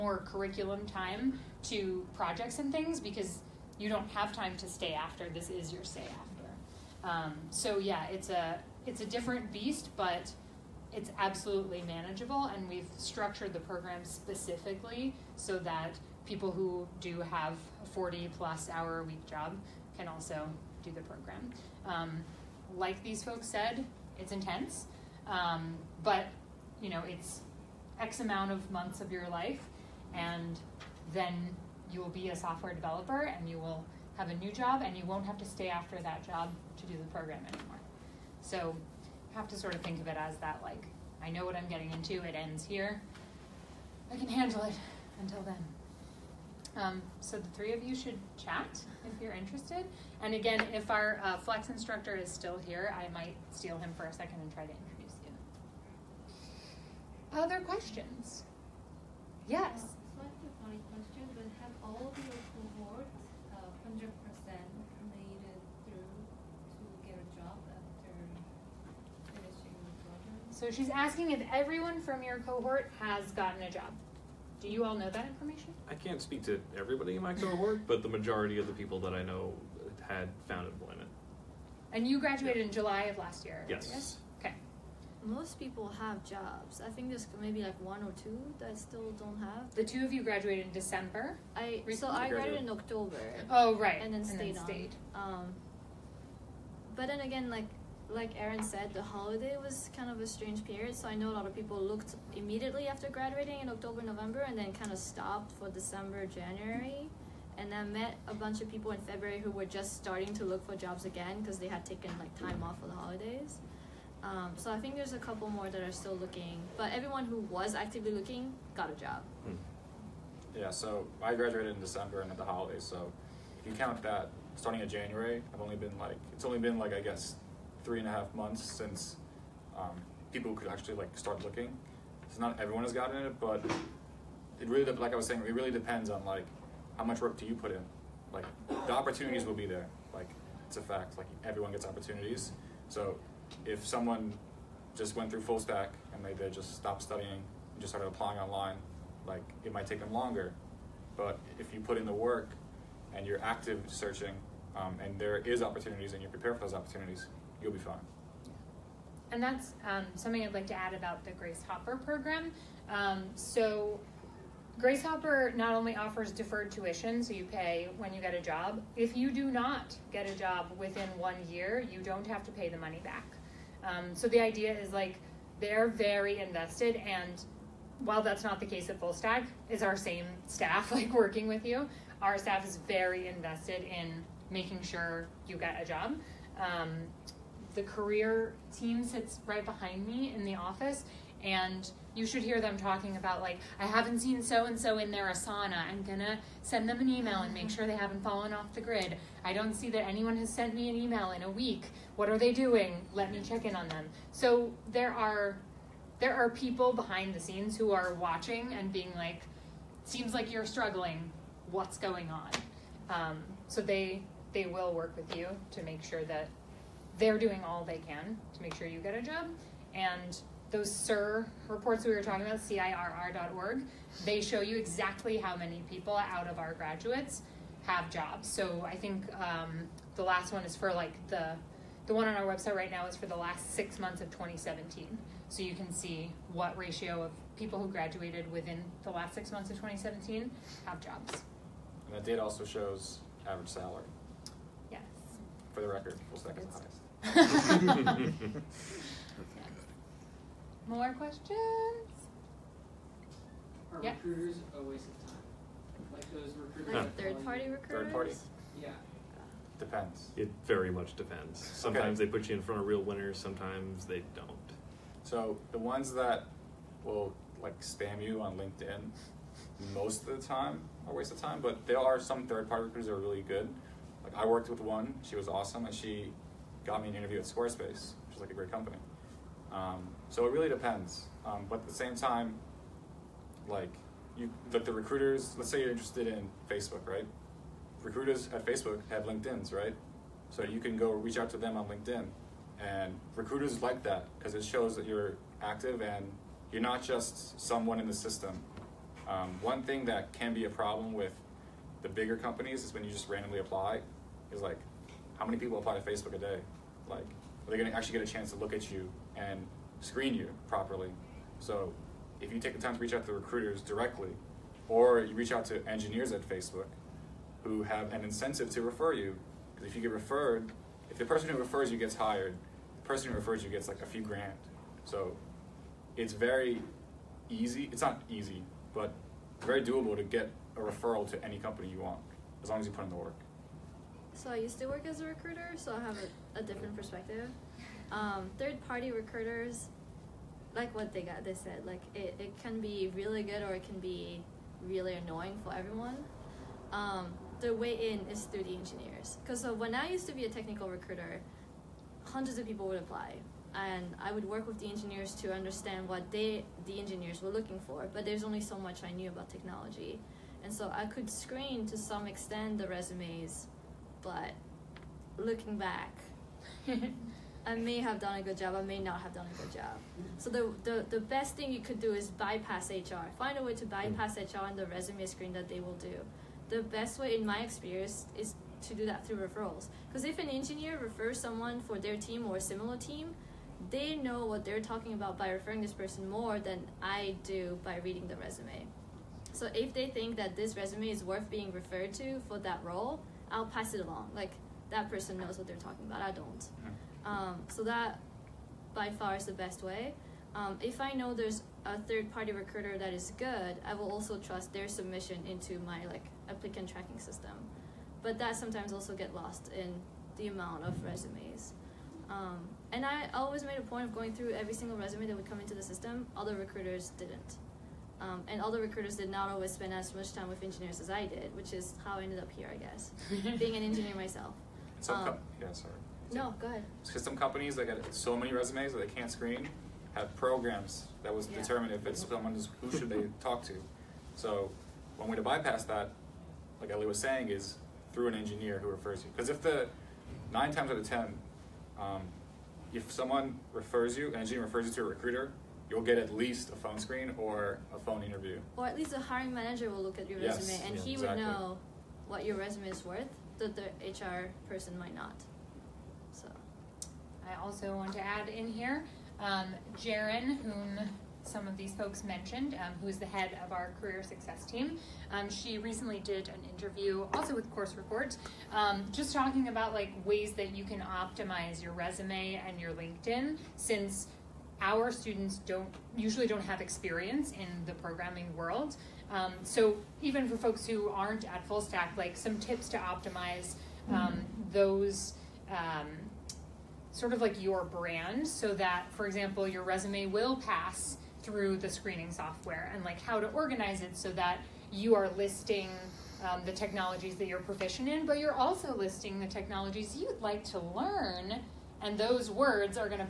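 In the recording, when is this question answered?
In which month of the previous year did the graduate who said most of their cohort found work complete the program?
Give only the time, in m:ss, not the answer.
1:22.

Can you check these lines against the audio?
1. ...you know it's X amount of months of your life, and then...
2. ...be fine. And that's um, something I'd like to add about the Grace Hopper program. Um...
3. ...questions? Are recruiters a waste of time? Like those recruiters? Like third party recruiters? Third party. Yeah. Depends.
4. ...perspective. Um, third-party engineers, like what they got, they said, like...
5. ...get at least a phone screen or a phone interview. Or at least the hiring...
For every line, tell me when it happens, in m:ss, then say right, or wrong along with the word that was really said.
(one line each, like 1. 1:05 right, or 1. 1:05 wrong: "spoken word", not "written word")
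1. 0:26 right
2. 2:37 right
3. 4:11 right
4. 5:36 wrong: "recruiters", not "engineers"
5. 7:26 right.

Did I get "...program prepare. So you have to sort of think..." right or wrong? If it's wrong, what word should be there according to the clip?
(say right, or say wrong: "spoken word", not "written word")
wrong: "anymore", not "prepare".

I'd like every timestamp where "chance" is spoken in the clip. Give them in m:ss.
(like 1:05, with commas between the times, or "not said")
5:08.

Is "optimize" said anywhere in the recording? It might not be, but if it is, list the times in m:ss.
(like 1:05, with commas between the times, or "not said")
7:50, 8:02.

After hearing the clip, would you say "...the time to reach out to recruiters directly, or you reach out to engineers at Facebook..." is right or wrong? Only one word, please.
right.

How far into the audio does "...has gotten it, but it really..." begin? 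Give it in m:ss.
2:12.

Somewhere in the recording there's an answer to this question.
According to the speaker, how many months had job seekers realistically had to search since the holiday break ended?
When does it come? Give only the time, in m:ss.
2:07.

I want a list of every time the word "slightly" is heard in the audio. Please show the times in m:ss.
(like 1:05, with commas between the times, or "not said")
1:00.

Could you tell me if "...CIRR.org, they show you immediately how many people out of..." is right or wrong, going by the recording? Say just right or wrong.
wrong.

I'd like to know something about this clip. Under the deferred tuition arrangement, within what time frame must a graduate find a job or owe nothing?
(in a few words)
one year.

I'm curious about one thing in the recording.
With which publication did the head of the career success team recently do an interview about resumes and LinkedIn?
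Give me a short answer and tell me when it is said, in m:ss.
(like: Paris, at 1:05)
Course Report, at 7:47.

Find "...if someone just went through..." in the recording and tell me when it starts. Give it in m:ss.
2:23.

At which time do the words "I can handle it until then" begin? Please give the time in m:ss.
0:44.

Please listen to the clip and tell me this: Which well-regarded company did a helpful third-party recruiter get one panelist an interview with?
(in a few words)
Squarespace.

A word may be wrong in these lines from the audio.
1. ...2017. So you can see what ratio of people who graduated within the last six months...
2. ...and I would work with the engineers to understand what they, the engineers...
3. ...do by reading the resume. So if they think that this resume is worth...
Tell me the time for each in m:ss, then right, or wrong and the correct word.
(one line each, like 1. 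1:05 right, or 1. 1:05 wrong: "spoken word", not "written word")
1. 3:54 right
2. 5:53 right
3. 6:27 right.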